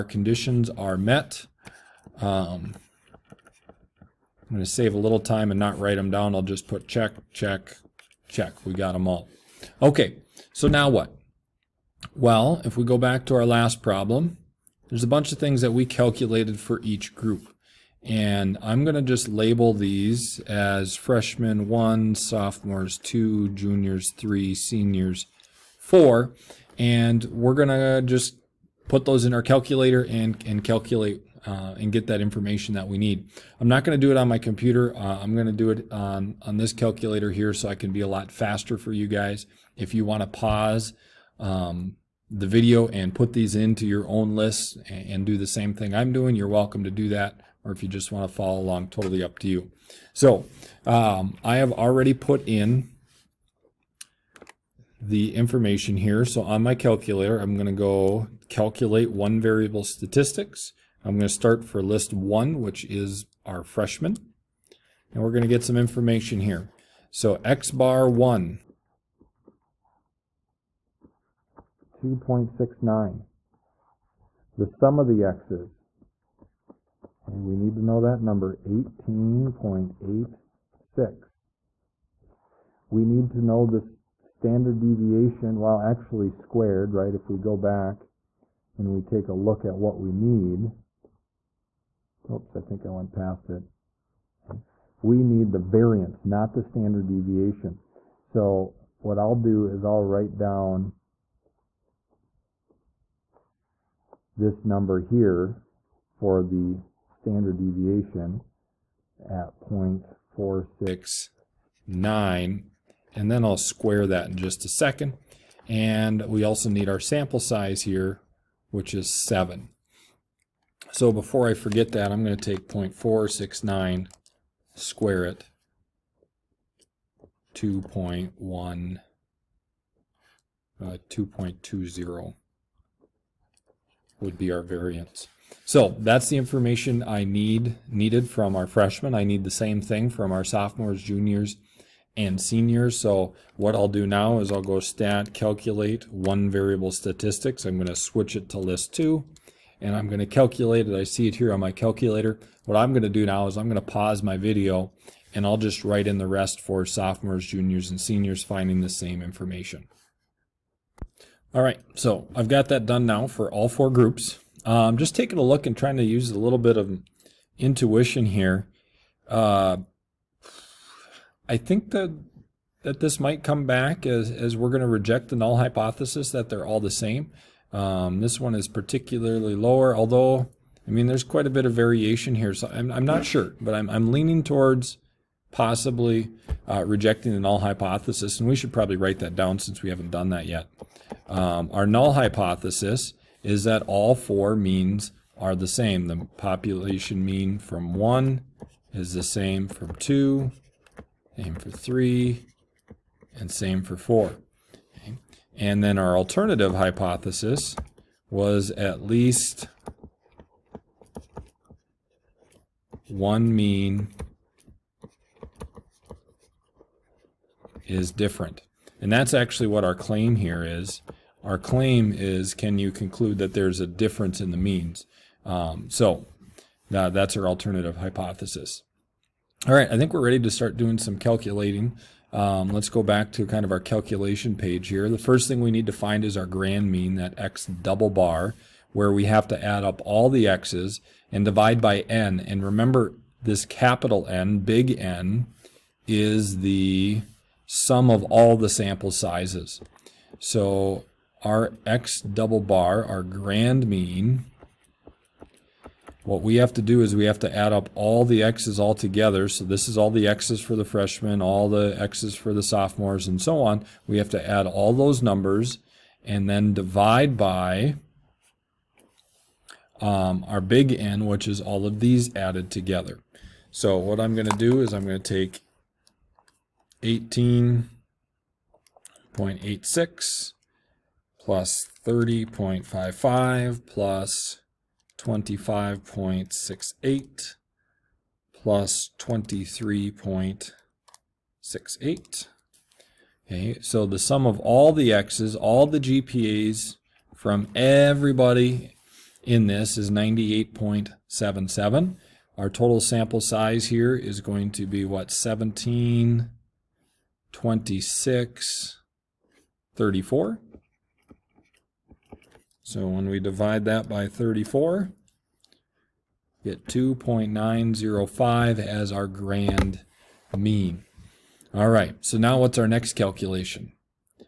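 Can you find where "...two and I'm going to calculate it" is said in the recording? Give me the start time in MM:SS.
02:28.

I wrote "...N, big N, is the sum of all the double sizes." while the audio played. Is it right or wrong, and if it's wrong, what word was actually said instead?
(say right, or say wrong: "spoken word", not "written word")
wrong: "sample", not "double".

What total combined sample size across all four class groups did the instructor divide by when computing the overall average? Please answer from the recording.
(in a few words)
34.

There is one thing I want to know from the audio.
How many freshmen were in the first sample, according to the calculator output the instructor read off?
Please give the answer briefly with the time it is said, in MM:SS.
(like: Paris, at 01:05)
7, at 01:59.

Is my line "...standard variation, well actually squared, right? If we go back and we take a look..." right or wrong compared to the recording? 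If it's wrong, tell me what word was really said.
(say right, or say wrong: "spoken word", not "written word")
wrong: "deviation", not "variation".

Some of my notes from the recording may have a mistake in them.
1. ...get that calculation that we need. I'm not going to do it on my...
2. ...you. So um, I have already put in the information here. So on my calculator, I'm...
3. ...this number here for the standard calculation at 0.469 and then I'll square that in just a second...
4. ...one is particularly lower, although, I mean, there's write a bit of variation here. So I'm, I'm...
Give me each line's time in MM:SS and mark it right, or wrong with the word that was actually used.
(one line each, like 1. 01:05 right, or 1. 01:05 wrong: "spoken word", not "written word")
1. 00:31 wrong: "information", not "calculation"
2. 00:49 right
3. 01:44 wrong: "deviation", not "calculation"
4. 02:58 wrong: "quite", not "write".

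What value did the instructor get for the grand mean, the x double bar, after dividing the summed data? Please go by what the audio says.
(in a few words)
2.905.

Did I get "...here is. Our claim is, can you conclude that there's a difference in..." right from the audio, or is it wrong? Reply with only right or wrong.
right.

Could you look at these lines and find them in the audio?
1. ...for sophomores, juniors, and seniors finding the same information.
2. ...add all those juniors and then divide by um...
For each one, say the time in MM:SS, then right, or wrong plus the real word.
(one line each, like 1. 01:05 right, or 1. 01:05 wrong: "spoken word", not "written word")
1. 02:36 right
2. 04:24 wrong: "numbers", not "juniors".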